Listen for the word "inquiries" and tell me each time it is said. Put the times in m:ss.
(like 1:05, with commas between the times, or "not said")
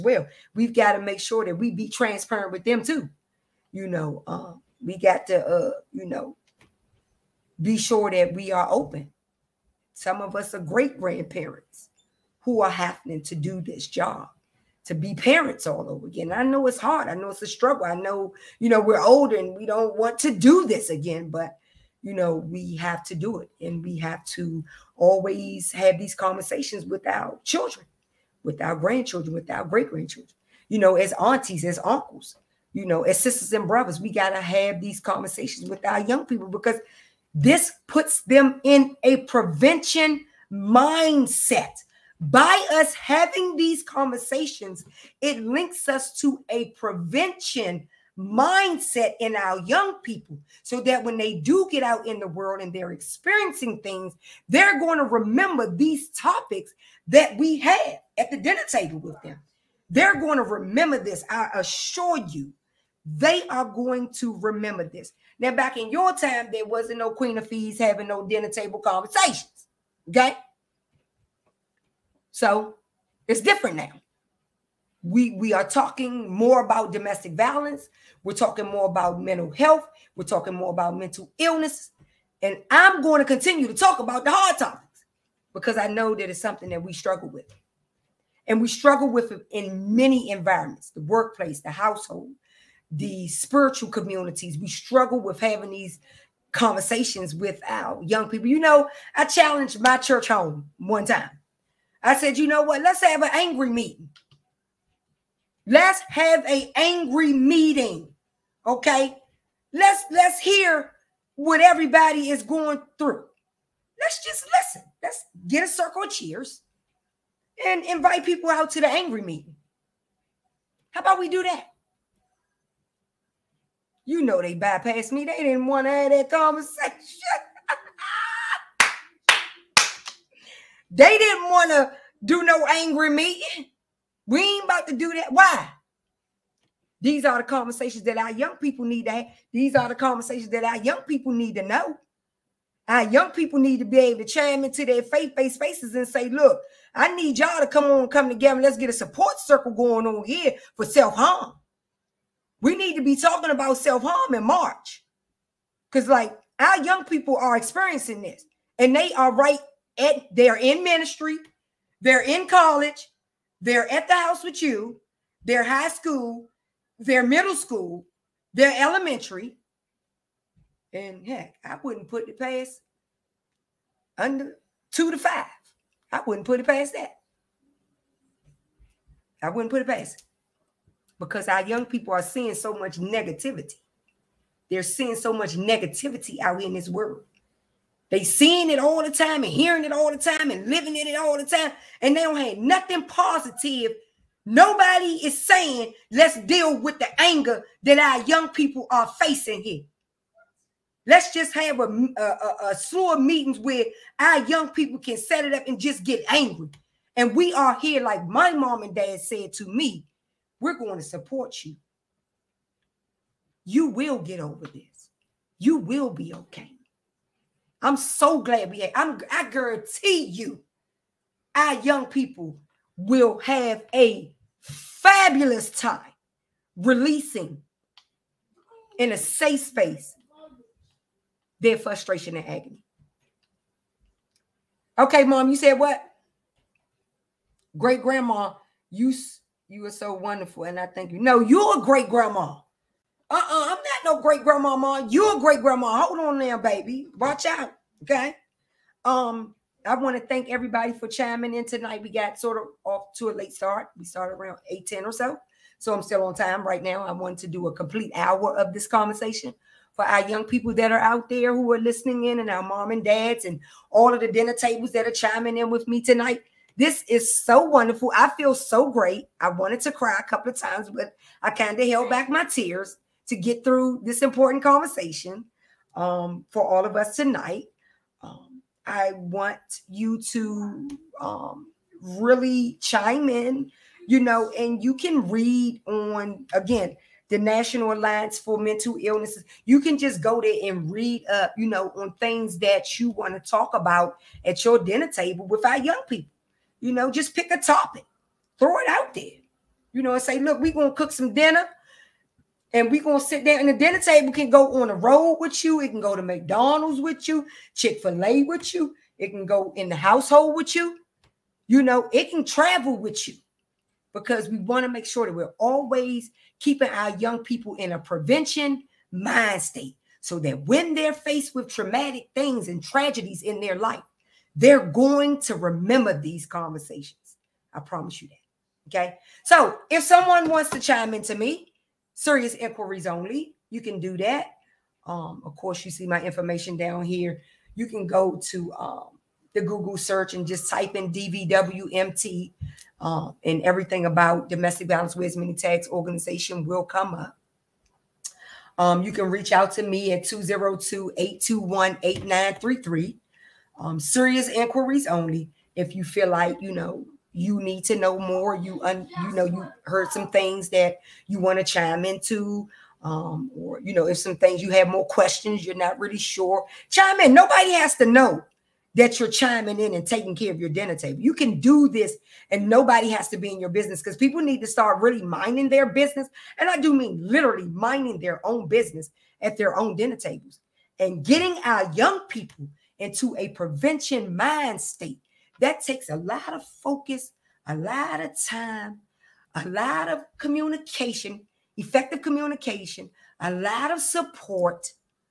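5:32, 5:54.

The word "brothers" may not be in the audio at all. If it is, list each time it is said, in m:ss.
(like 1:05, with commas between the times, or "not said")
0:33.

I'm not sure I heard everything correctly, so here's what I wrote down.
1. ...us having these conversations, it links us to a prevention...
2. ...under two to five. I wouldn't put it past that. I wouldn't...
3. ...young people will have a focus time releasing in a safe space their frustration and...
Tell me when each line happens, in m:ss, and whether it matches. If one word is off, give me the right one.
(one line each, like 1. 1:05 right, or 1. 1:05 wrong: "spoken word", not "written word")
1. 0:42 right
2. 2:54 right
3. 3:41 wrong: "fabulous", not "focus".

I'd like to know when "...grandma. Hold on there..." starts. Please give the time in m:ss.
4:05.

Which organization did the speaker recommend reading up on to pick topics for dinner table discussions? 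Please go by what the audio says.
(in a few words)
National Alliance for Mental Illnesses.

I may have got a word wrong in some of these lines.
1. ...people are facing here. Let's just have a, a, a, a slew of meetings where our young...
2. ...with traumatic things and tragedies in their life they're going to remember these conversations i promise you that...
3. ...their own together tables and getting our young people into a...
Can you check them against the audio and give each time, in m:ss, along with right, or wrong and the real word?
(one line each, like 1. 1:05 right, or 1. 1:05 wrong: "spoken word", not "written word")
1. 3:18 right
2. 5:21 right
3. 6:19 wrong: "dinner", not "together".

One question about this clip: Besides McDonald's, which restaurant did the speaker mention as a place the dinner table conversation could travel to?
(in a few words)
Chick-fil-A.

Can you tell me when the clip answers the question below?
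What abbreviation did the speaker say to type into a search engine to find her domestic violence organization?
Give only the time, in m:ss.
5:41.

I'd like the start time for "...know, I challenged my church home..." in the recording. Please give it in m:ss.
1:38.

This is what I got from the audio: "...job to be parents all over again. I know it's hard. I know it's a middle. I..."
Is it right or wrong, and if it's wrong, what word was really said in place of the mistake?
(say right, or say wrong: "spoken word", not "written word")
wrong: "struggle", not "middle".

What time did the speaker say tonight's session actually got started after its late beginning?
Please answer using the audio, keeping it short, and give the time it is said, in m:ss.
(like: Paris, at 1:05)
8:10, at 4:14.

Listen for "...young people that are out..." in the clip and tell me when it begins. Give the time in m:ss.
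4:20.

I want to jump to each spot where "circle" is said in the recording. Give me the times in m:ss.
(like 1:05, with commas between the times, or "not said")
1:55, 2:29.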